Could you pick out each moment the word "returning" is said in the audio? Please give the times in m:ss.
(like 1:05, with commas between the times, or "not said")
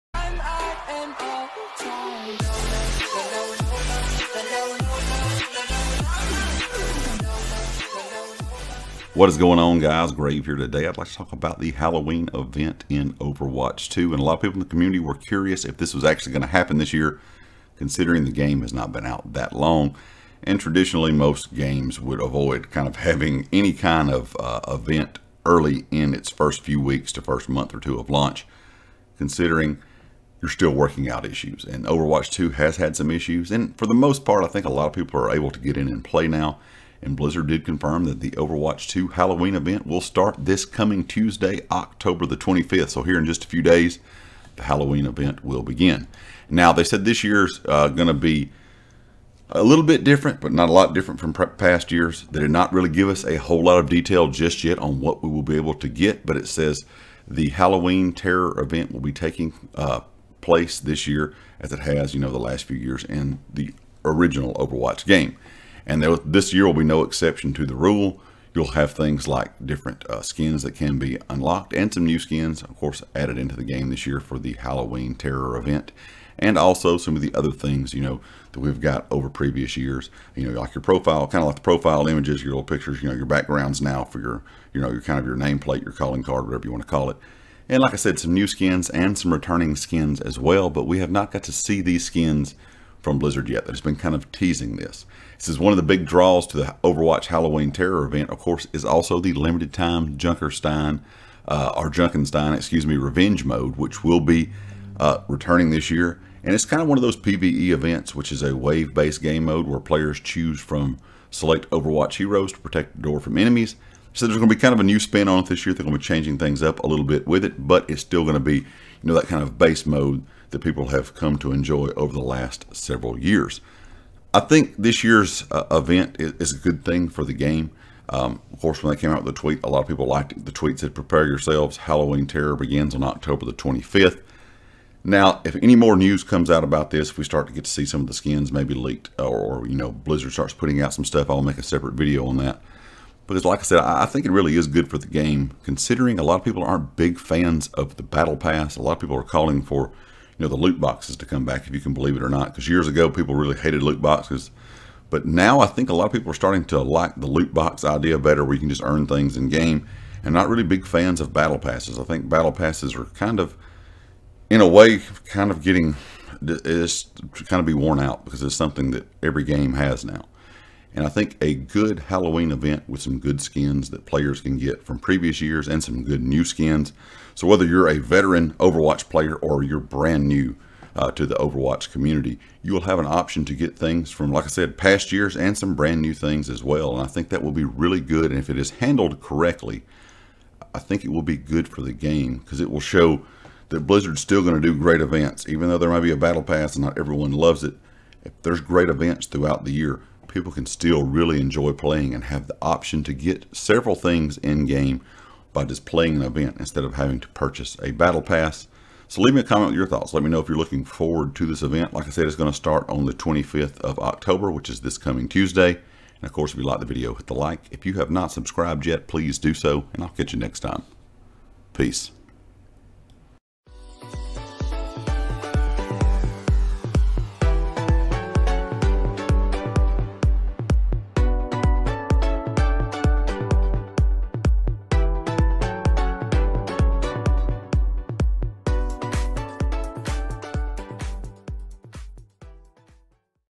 1:29, 1:45.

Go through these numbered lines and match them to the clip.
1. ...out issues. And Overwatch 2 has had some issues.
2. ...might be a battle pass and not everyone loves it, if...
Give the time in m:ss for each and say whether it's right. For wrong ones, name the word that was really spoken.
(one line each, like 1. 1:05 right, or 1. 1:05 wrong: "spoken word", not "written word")
1. 0:31 right
2. 3:15 right.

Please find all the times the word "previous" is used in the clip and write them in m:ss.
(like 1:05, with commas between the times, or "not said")
1:19, 2:54.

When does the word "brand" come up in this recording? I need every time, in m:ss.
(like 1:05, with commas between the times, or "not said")
2:59, 3:05.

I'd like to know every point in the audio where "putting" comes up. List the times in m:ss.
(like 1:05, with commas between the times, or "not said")
2:20.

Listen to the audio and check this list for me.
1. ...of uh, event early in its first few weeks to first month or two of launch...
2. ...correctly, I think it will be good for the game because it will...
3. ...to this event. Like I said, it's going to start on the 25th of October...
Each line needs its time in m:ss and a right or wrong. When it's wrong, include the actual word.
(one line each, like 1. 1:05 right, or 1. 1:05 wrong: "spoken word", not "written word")
1. 0:24 right
2. 3:09 right
3. 3:31 right.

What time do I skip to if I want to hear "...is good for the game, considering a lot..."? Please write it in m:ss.
2:24.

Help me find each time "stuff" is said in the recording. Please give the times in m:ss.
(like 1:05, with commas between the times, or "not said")
2:21.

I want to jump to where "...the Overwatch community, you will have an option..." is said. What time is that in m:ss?
3:01.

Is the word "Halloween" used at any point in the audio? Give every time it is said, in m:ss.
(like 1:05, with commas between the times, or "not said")
0:11, 0:39, 0:44, 0:57, 1:14, 1:37, 2:11, 2:51.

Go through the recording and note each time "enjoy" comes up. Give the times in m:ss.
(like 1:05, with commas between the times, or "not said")
2:01, 3:21.